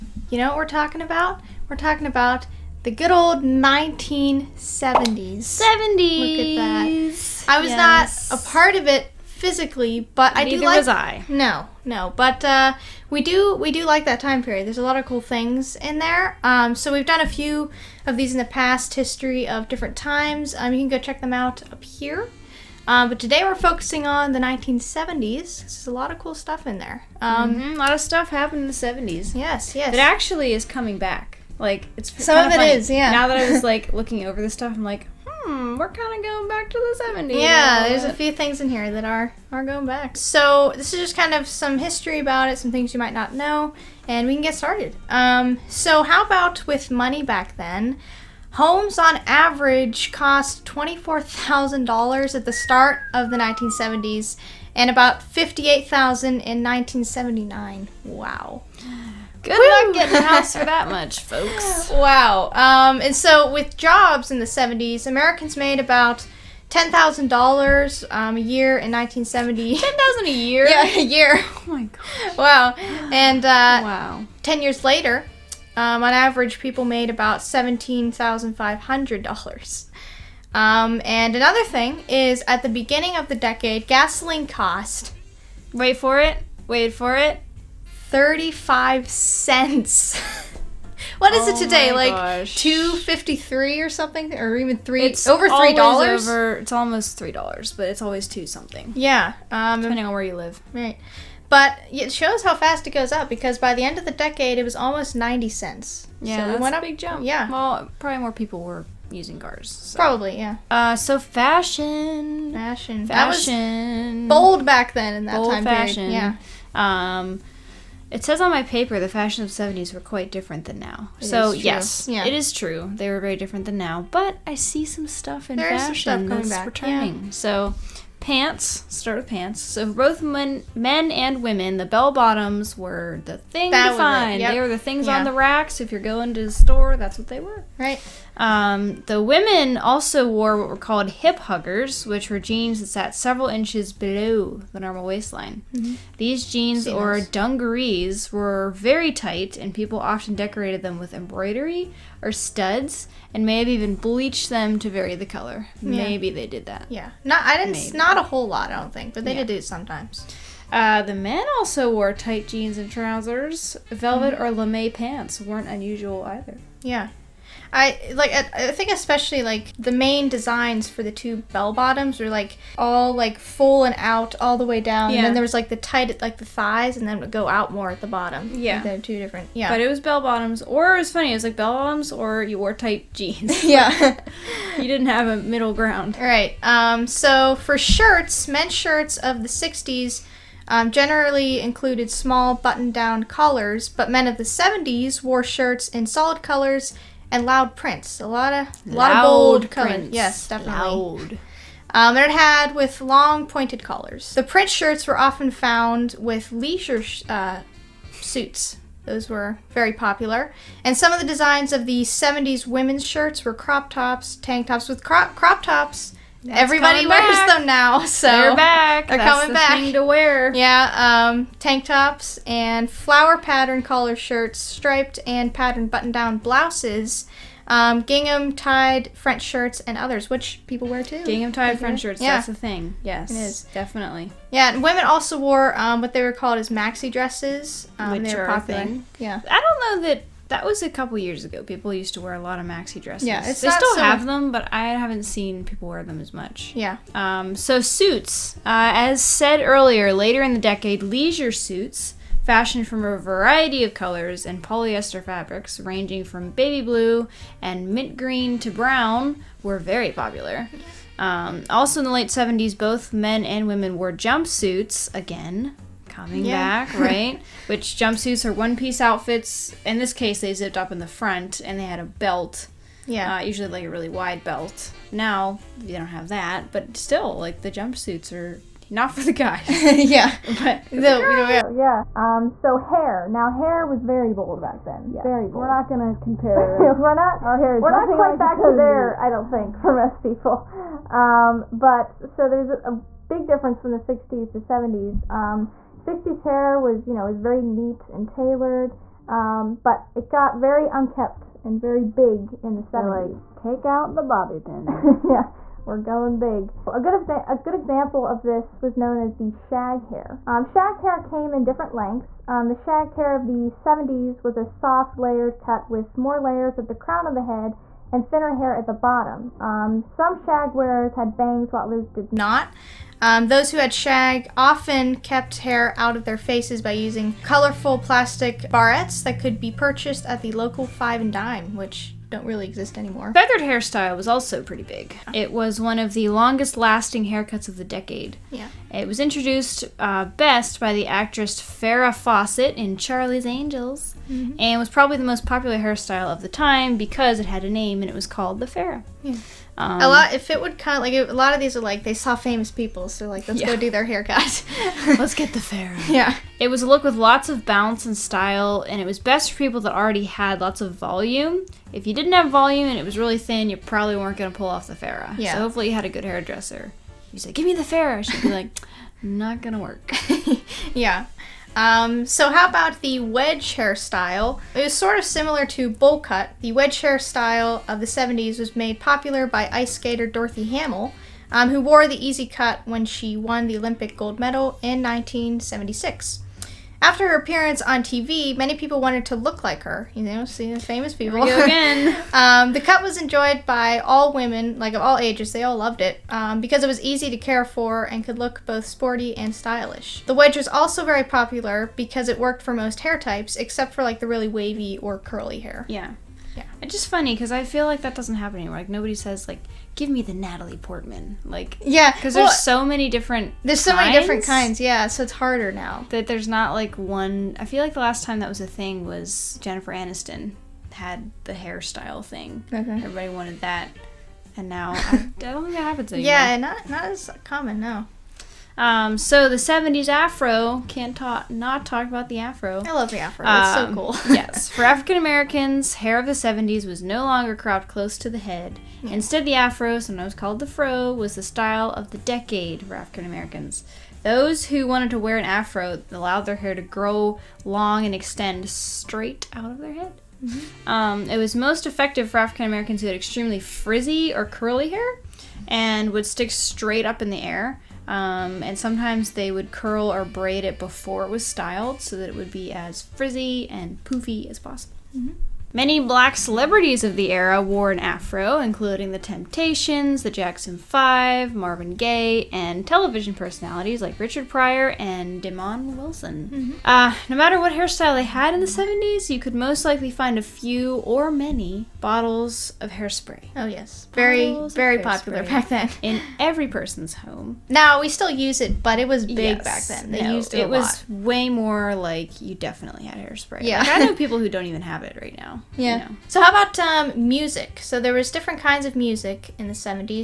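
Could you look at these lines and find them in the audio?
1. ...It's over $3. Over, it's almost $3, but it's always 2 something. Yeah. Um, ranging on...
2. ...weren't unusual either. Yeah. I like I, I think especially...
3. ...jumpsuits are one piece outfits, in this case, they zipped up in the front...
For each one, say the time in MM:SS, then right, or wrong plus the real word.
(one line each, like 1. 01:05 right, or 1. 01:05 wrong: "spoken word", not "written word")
1. 01:35 wrong: "depending", not "ranging"
2. 02:45 right
3. 04:27 right.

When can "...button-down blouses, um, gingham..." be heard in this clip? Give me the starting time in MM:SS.
03:45.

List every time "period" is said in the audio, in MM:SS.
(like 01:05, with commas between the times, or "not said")
00:14, 01:56.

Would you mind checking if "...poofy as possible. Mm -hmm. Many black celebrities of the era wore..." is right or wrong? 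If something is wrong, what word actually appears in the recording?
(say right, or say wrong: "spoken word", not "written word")
right.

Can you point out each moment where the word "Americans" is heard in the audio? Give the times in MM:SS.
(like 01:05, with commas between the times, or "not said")
01:05, 07:15, 07:23, 07:32.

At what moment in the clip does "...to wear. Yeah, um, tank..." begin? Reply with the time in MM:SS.
03:39.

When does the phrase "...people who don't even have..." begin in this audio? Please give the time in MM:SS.
08:14.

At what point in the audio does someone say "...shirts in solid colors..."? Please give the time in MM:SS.
03:15.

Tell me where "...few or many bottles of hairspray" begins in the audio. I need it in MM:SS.
08:00.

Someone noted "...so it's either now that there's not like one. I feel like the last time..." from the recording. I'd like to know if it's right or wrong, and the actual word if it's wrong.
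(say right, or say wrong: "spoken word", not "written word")
wrong: "harder", not "either".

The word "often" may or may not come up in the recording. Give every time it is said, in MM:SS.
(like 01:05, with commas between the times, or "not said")
02:29, 03:25, 05:24.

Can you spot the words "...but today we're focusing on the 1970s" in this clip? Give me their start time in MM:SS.
00:23.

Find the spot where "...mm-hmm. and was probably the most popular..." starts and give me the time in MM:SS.
05:44.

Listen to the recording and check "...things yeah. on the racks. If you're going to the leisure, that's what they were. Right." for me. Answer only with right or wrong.
wrong.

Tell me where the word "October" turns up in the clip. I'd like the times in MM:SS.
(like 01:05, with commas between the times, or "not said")
not said.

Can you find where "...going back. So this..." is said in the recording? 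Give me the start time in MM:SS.
00:39.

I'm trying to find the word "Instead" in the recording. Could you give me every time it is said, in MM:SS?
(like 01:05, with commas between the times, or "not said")
07:19.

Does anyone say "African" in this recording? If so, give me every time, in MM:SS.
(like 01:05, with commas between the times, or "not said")
07:14, 07:22, 07:32.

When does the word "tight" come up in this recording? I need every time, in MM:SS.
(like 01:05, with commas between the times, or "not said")
02:29, 02:42, 02:55, 03:02.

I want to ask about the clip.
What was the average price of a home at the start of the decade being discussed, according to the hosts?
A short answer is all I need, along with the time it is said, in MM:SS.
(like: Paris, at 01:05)
$24,000, at 00:50.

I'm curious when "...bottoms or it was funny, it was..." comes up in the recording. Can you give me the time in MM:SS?
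03:00.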